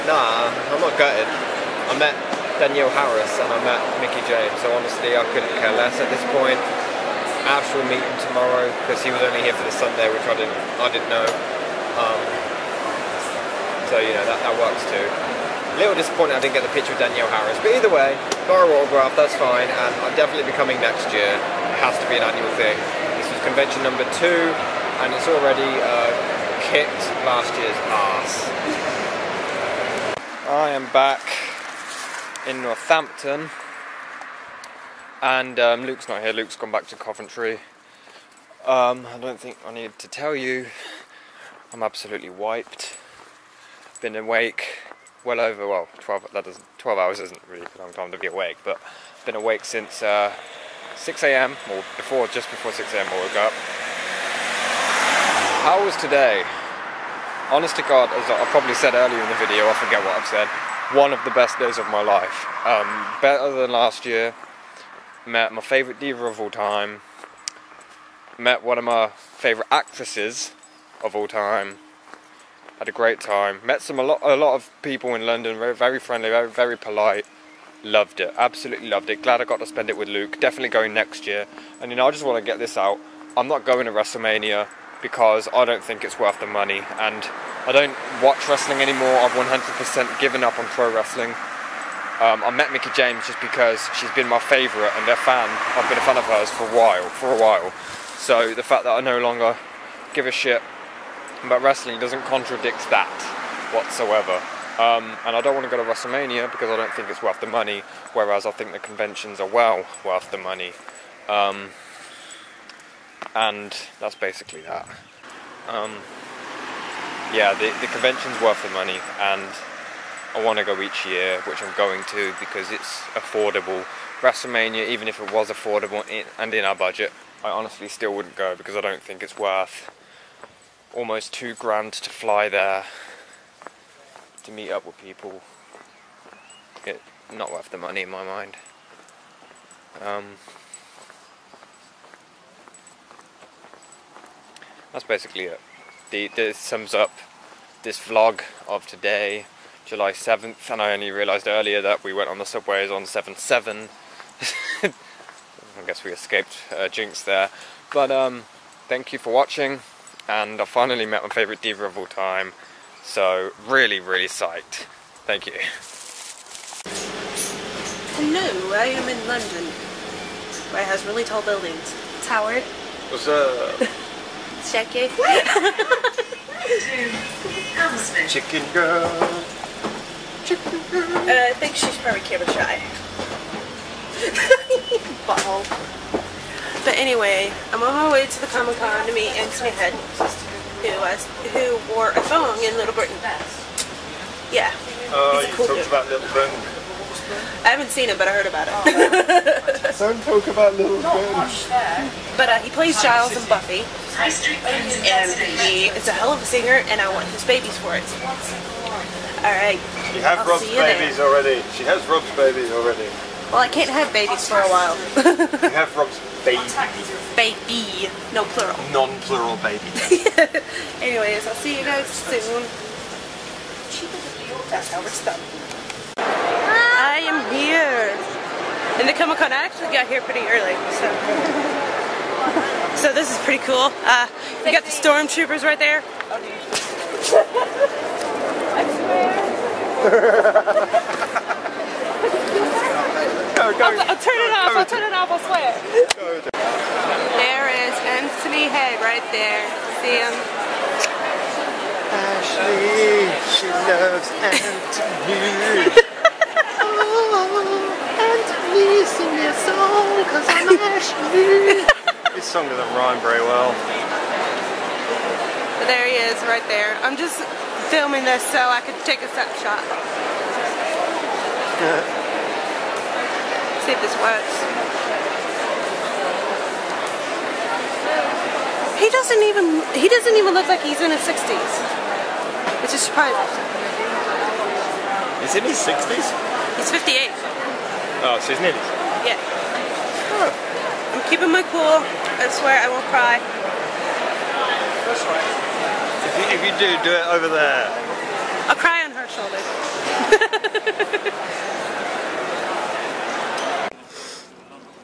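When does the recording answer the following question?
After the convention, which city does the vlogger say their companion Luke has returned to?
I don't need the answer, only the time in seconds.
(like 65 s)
36 s.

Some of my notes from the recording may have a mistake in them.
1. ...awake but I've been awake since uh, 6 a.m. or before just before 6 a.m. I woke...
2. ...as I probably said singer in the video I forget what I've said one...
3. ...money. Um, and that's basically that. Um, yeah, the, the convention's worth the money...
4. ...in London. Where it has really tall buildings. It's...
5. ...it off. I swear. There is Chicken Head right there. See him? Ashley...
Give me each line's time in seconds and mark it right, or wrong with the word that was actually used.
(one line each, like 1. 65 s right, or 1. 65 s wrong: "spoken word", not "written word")
1. 48 s right
2. 58 s wrong: "earlier", not "singer"
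3. 110 s right
4. 169 s right
5. 245 s wrong: "Anthony", not "Chicken".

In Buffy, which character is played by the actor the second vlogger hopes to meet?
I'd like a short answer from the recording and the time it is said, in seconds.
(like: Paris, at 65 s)
Giles, at 203 s.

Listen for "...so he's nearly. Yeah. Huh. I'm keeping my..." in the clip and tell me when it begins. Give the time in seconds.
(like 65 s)
288 s.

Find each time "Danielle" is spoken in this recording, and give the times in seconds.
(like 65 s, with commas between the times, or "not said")
2 s, 17 s.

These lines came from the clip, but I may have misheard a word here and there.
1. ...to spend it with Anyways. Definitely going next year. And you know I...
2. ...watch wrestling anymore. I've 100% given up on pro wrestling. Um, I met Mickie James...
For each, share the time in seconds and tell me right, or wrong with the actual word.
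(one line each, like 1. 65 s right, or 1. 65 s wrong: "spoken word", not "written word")
1. 79 s wrong: "Luke", not "Anyways"
2. 88 s right.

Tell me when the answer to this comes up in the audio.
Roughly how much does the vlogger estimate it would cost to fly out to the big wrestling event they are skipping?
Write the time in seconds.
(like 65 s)
130 s.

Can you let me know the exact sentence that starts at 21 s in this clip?
It has to be an annual thing.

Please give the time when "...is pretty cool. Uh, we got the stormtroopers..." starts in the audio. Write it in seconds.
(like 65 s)
233 s.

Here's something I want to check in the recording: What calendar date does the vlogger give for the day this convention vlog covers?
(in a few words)
July 7th.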